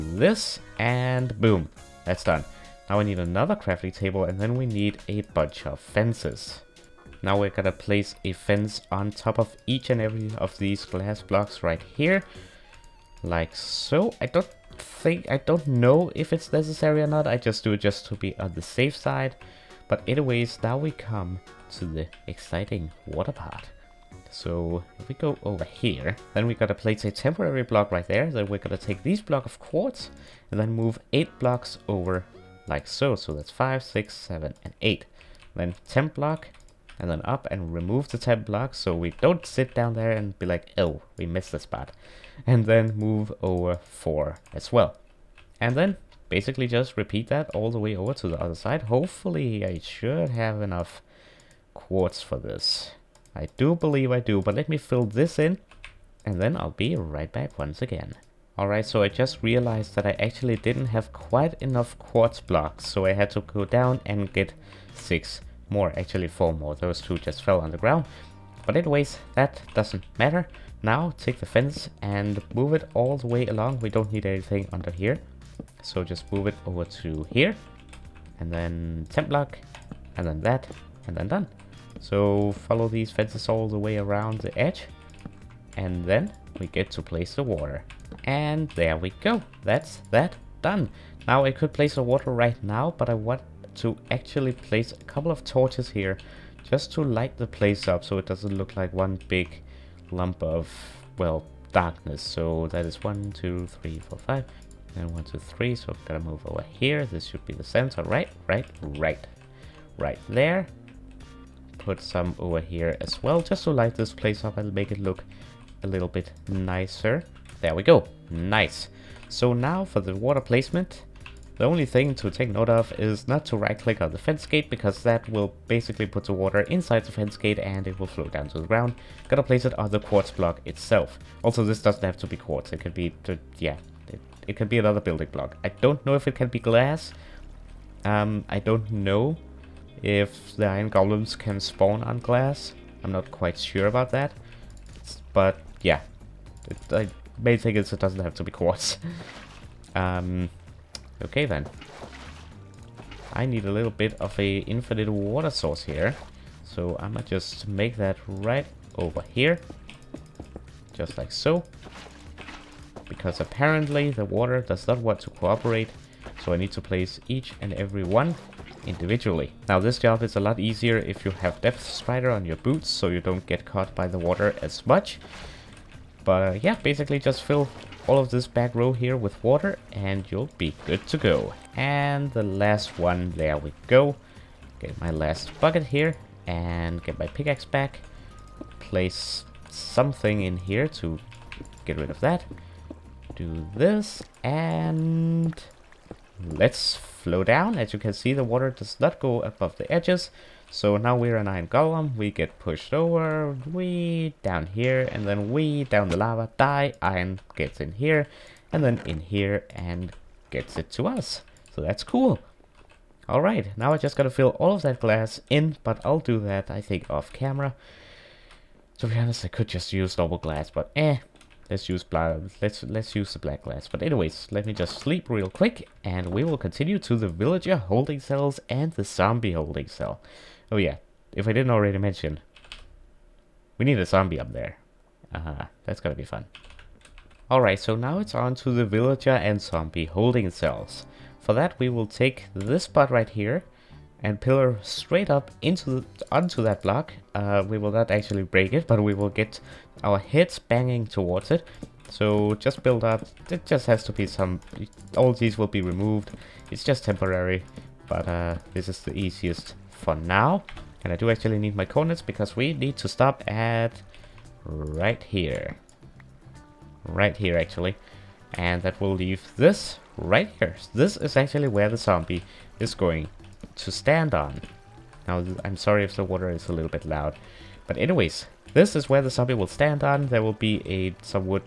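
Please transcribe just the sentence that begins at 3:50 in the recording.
Oh yeah, if I didn't already mention, we need a zombie up there.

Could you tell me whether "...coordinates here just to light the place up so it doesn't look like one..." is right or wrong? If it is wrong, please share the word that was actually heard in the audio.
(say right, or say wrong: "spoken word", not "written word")
wrong: "torches", not "coordinates".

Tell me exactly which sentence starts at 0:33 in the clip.
So that's five, six, seven, and eight.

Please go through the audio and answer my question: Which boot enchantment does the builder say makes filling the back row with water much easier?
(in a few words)
Depth Strider.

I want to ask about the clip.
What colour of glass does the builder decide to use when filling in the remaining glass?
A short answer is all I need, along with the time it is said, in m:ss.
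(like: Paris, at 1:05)
Black, at 3:43.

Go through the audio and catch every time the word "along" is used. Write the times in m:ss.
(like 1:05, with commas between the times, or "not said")
1:13.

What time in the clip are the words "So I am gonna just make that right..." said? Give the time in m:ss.
2:36.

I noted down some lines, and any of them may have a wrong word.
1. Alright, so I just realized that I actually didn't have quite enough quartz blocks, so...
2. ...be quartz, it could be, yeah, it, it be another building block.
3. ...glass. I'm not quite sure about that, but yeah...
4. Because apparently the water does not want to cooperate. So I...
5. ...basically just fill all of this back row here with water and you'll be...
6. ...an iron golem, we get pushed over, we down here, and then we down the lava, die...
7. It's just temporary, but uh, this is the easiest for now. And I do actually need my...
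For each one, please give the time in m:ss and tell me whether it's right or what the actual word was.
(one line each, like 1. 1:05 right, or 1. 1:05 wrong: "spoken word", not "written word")
1. 0:58 right
2. 2:12 right
3. 2:22 right
4. 2:43 right
5. 2:56 right
6. 3:21 right
7. 4:16 right.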